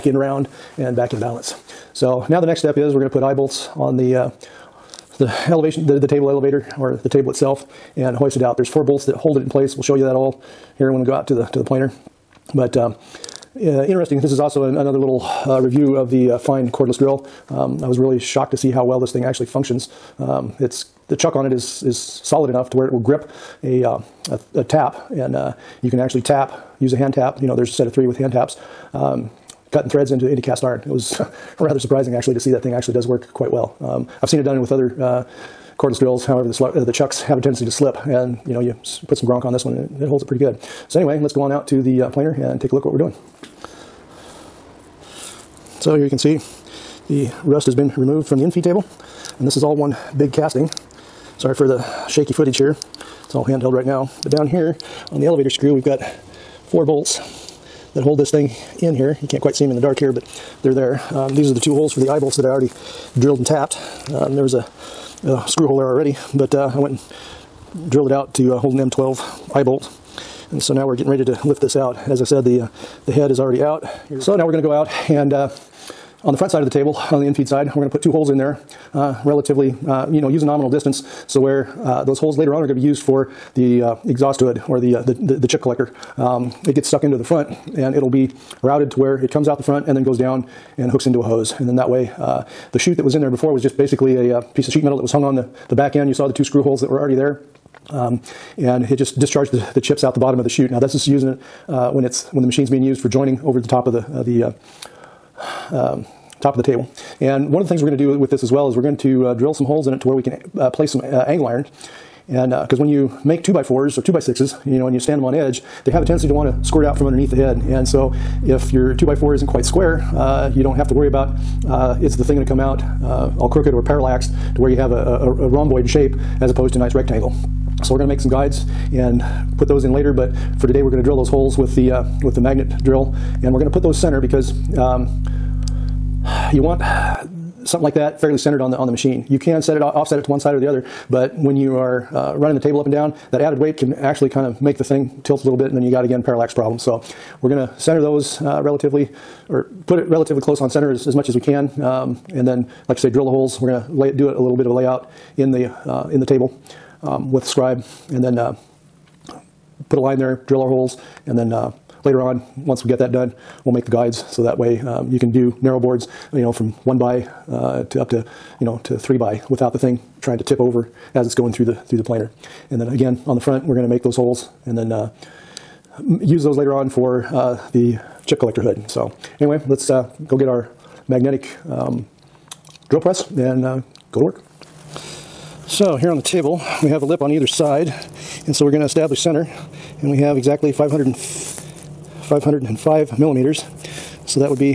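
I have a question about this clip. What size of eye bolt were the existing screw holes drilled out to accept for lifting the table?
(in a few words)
M12.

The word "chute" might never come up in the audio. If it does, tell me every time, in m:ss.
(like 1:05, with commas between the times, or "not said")
1:32, 1:40.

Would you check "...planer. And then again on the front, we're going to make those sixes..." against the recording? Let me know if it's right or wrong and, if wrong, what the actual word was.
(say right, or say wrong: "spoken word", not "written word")
wrong: "holes", not "sixes".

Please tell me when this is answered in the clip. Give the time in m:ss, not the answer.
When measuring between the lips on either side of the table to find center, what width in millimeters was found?
3:11.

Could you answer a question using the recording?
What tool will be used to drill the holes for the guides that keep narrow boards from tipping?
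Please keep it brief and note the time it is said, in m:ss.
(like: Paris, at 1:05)
magnet drill, at 2:12.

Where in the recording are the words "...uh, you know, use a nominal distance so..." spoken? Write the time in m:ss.
1:19.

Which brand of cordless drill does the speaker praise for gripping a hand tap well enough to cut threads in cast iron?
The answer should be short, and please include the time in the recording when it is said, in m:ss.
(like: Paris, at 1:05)
Fein, at 0:16.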